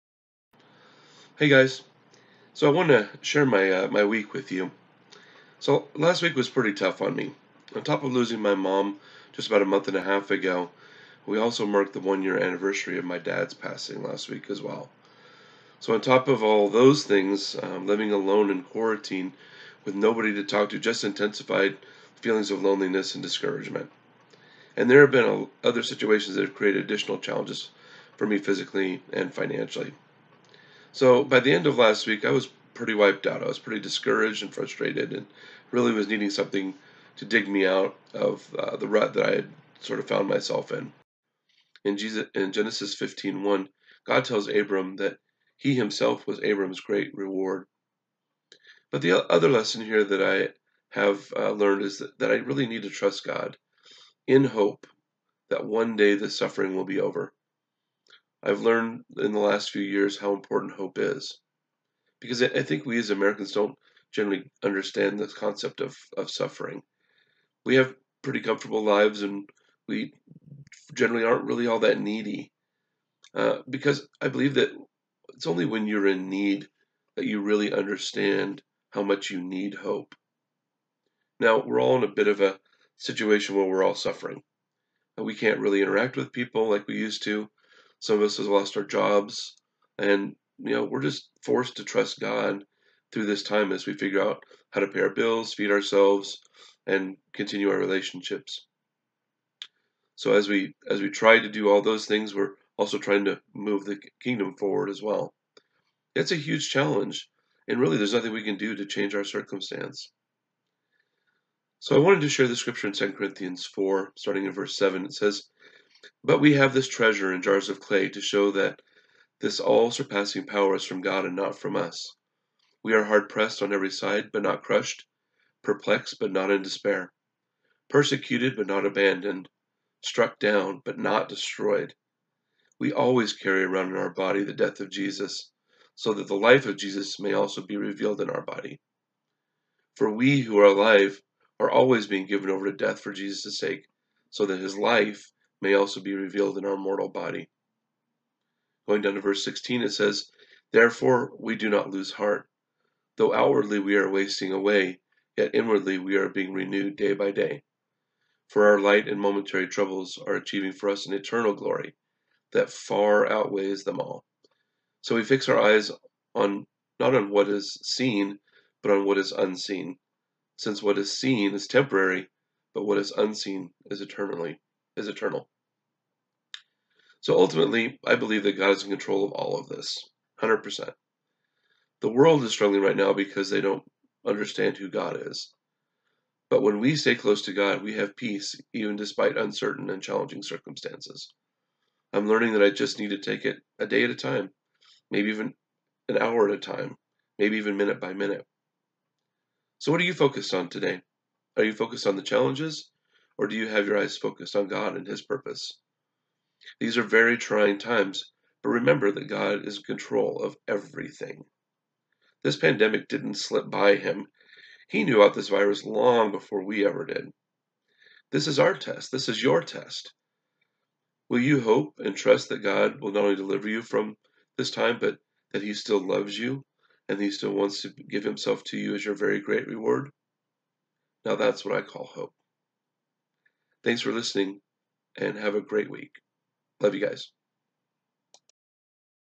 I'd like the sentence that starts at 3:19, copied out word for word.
So, what are you focused on today?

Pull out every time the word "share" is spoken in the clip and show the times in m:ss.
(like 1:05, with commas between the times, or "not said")
0:03, 1:52.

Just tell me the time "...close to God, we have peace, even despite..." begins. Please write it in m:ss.
3:07.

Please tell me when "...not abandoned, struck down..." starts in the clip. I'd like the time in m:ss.
2:08.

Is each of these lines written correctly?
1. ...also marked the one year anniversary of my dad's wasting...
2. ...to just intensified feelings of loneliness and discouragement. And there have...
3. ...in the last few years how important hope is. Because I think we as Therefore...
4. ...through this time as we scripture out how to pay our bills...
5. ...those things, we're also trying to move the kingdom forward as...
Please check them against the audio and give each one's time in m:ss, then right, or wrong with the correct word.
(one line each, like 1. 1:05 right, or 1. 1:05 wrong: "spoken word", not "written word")
1. 0:11 wrong: "passing", not "wasting"
2. 0:20 right
3. 0:59 wrong: "Americans", not "Therefore"
4. 1:33 wrong: "figure", not "scripture"
5. 1:41 right.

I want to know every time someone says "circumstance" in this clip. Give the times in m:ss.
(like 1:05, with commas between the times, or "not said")
1:49, 3:10.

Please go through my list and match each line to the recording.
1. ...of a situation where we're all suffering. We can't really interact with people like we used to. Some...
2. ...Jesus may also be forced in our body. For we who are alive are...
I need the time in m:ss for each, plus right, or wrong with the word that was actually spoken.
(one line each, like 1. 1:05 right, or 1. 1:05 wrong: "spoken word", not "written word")
1. 1:22 right
2. 2:16 wrong: "revealed", not "forced".